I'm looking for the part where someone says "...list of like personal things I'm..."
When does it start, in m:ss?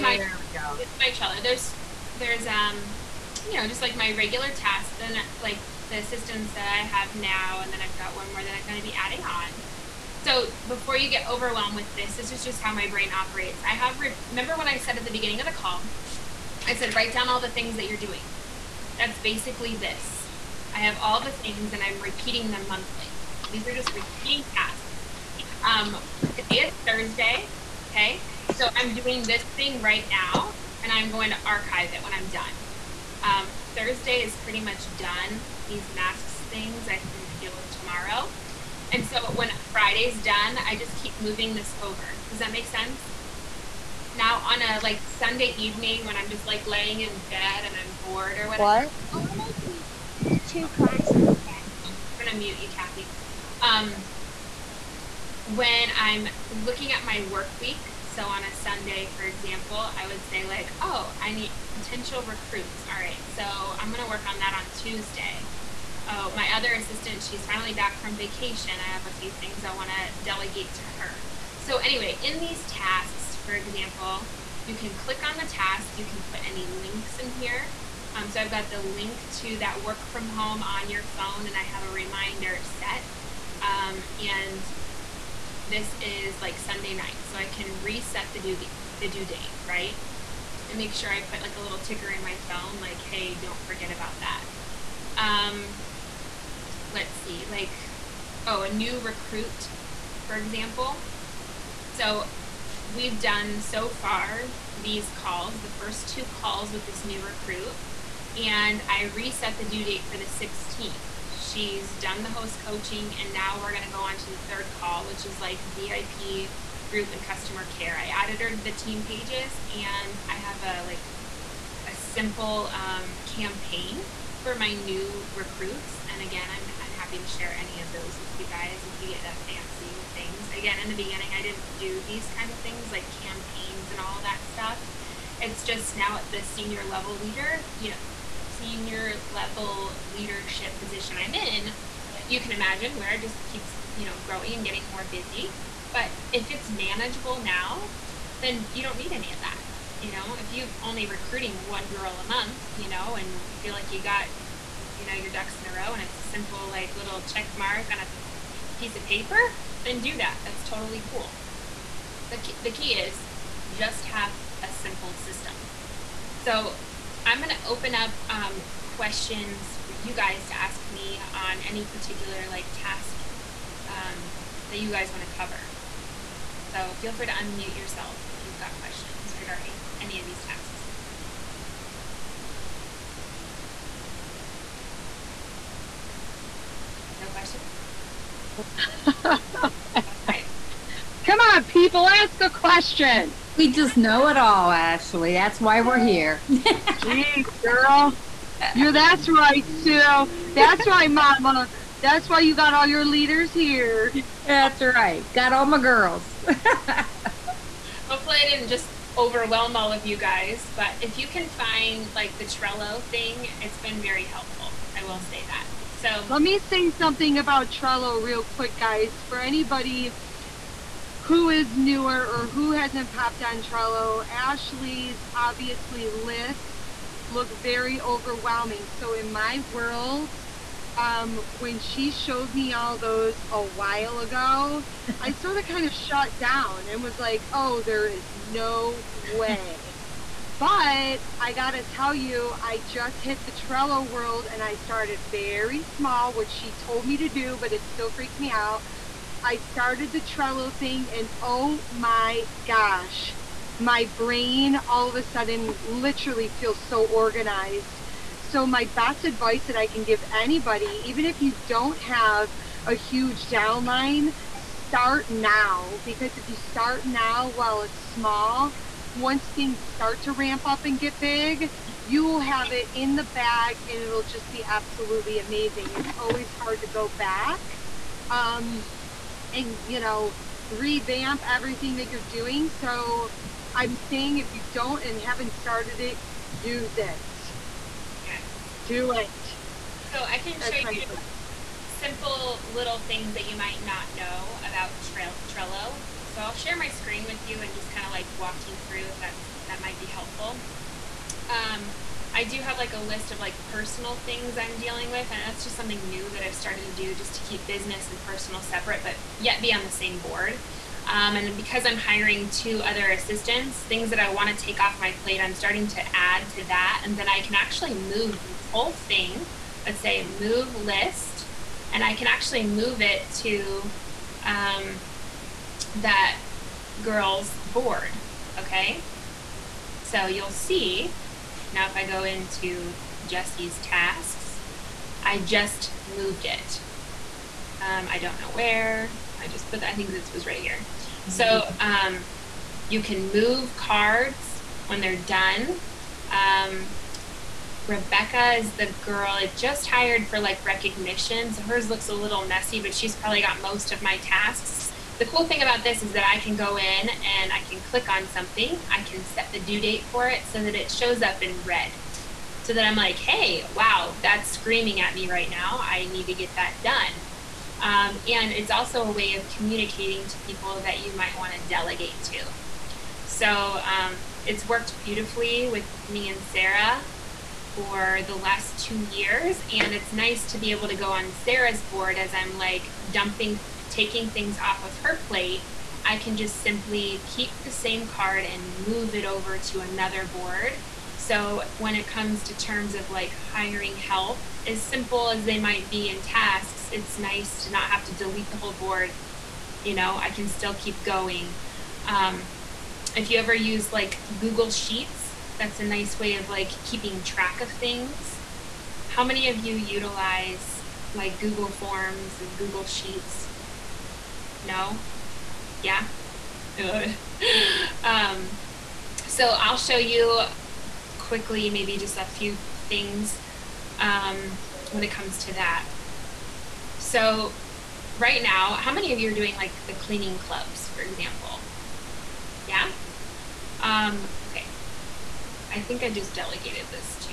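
5:03.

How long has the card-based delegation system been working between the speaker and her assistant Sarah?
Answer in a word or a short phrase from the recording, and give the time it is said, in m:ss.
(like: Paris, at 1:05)
2 years, at 6:18.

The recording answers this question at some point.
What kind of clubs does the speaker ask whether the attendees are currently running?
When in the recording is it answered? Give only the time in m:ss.
7:09.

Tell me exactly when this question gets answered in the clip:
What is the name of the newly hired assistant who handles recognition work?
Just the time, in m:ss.
5:47.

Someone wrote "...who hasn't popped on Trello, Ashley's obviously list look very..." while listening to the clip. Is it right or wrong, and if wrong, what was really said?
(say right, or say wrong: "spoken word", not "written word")
right.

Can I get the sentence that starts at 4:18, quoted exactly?
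So, my best advice that I can give anybody, even if you don't have a huge downline, start now.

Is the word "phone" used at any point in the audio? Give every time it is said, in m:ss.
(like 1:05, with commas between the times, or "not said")
1:21, 1:32.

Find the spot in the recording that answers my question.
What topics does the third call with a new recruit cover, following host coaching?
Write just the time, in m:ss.
1:55.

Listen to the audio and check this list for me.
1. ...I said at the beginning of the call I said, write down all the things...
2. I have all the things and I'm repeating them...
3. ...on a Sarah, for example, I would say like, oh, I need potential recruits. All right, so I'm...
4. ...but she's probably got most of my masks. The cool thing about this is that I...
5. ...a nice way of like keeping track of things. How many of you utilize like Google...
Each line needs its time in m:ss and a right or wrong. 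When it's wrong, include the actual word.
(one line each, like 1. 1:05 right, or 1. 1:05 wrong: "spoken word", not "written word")
1. 0:14 right
2. 0:20 right
3. 0:58 wrong: "Sunday", not "Sarah"
4. 5:52 wrong: "tasks", not "masks"
5. 6:45 right.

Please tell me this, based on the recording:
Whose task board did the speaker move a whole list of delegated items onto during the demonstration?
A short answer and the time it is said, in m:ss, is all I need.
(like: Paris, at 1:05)
Jesse's, at 5:33.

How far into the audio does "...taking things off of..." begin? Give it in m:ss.
6:23.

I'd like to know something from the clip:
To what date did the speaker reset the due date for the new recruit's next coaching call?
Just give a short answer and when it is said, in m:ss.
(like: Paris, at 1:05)
16th, at 1:50.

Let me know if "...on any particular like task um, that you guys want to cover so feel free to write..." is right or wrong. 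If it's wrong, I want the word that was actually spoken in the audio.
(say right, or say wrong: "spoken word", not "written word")
wrong: "unmute", not "write".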